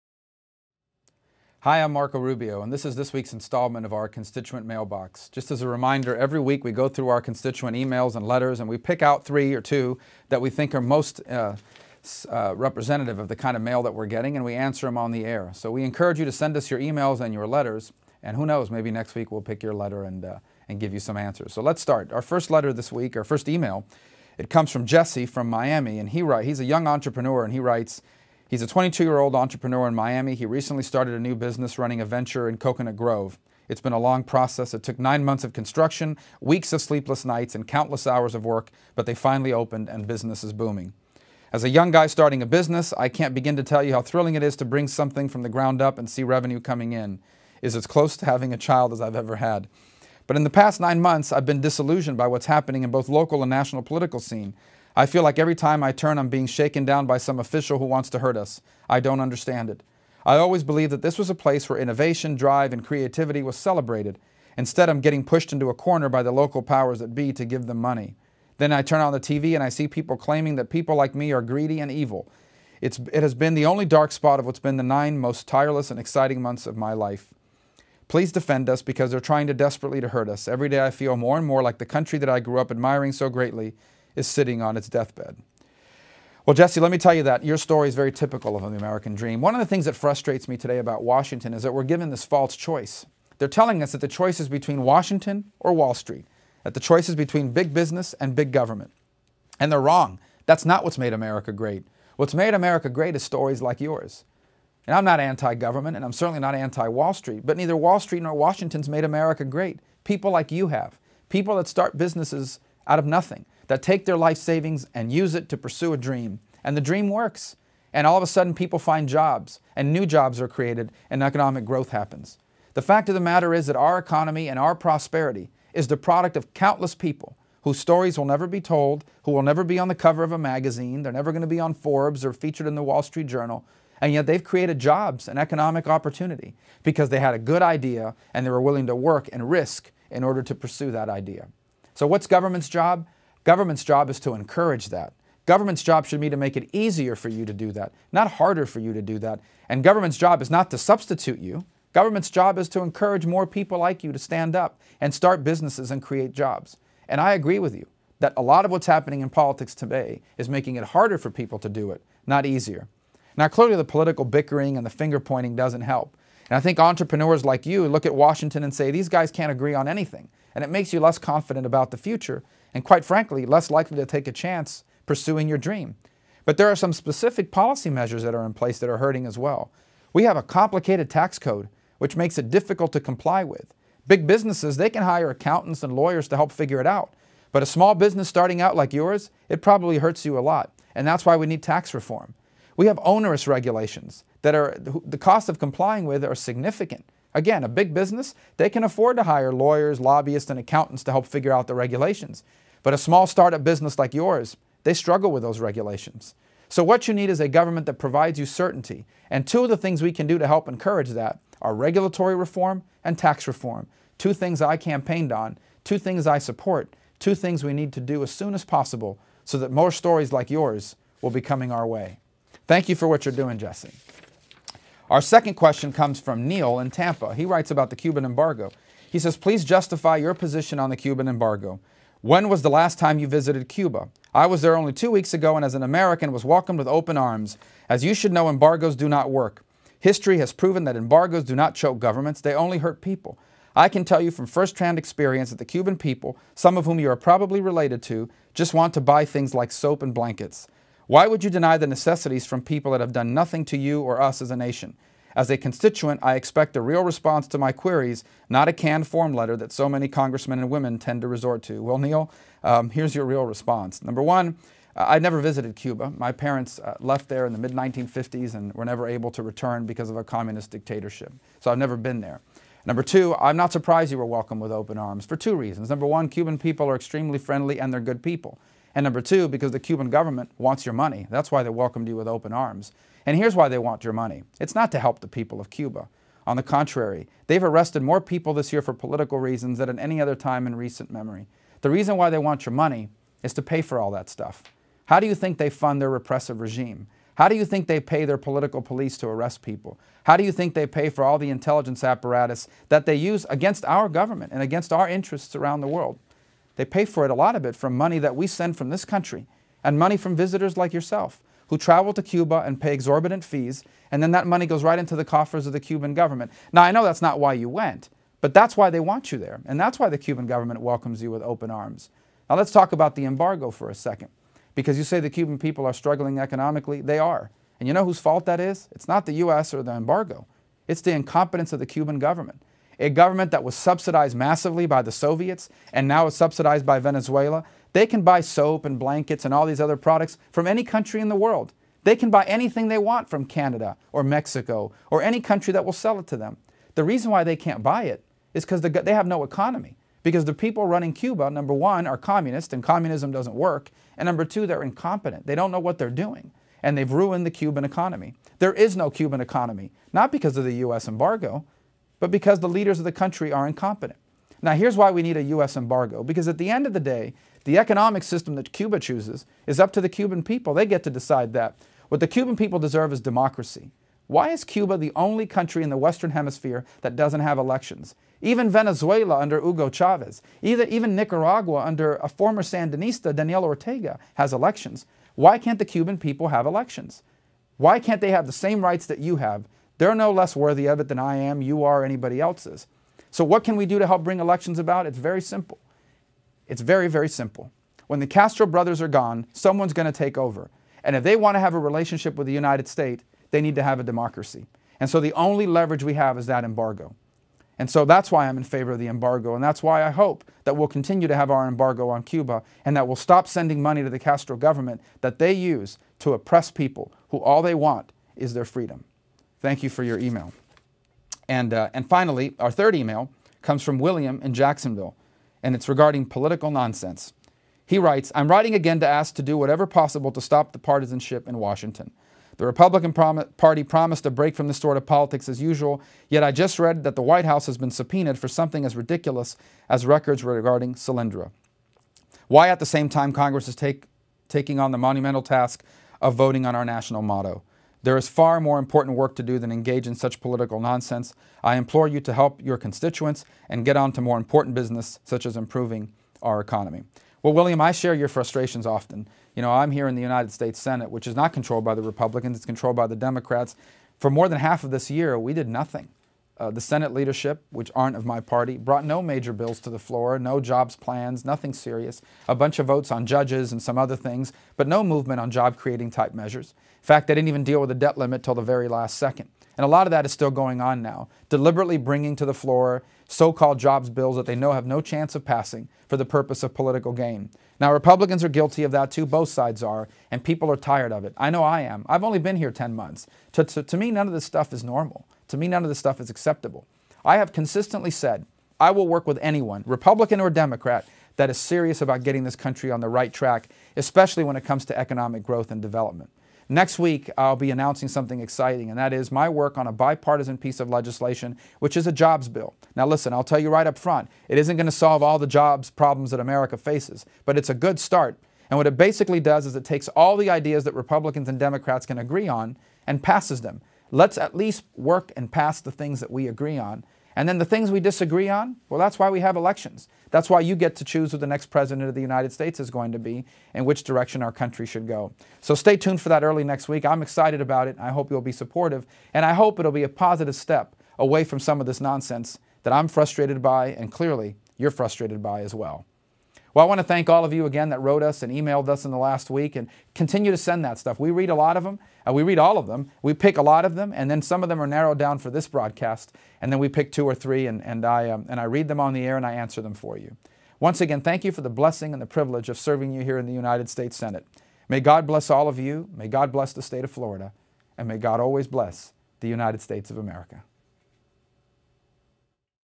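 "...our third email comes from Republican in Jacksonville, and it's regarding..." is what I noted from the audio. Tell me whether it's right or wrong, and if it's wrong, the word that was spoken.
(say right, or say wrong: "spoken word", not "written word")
wrong: "William", not "Republican".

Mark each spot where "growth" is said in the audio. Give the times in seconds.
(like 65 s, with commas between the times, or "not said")
121 s, 505 s.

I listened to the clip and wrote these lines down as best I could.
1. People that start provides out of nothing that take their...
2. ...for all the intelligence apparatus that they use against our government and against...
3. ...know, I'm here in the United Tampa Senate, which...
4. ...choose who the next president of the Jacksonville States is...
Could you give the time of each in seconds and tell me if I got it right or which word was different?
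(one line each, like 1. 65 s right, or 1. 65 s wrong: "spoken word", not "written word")
1. 111 s wrong: "businesses", not "provides"
2. 301 s right
3. 459 s wrong: "States", not "Tampa"
4. 531 s wrong: "United", not "Jacksonville".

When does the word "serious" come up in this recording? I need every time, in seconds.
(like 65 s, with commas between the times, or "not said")
471 s, 501 s.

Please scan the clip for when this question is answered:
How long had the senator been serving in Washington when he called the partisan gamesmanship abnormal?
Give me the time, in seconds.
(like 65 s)
492 s.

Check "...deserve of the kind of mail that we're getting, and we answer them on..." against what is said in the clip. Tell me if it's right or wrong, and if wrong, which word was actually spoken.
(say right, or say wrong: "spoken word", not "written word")
wrong: "representative", not "deserve".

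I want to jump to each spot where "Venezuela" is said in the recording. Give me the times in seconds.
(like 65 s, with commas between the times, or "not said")
336 s, 378 s.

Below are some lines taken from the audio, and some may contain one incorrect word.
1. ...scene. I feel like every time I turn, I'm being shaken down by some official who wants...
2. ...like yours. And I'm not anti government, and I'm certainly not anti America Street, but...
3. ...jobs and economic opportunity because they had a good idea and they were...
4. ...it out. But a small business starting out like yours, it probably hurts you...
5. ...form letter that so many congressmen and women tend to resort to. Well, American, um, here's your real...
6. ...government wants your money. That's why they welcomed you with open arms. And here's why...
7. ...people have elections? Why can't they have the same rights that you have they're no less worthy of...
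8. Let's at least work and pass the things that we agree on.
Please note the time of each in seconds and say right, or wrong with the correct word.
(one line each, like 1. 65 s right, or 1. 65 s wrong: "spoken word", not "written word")
1. 54 s right
2. 103 s wrong: "Wall", not "America"
3. 134 s right
4. 186 s right
5. 259 s wrong: "Neil", not "American"
6. 280 s right
7. 386 s right
8. 524 s right.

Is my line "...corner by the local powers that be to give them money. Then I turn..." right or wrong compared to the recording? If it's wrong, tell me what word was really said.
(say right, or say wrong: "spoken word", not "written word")
right.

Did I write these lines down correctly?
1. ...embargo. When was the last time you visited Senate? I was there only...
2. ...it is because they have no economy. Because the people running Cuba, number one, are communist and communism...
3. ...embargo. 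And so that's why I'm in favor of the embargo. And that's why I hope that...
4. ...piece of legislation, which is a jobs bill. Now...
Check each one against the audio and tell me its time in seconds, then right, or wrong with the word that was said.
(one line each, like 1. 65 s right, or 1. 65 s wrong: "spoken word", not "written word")
1. 231 s wrong: "Cuba", not "Senate"
2. 348 s right
3. 406 s right
4. 510 s right.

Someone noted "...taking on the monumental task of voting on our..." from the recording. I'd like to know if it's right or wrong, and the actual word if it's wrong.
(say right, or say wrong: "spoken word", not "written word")
right.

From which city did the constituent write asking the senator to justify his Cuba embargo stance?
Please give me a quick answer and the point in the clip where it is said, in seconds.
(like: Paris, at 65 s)
Tampa, at 226 s.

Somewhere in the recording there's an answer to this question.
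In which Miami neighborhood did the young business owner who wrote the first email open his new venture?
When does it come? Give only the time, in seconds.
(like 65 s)
32 s.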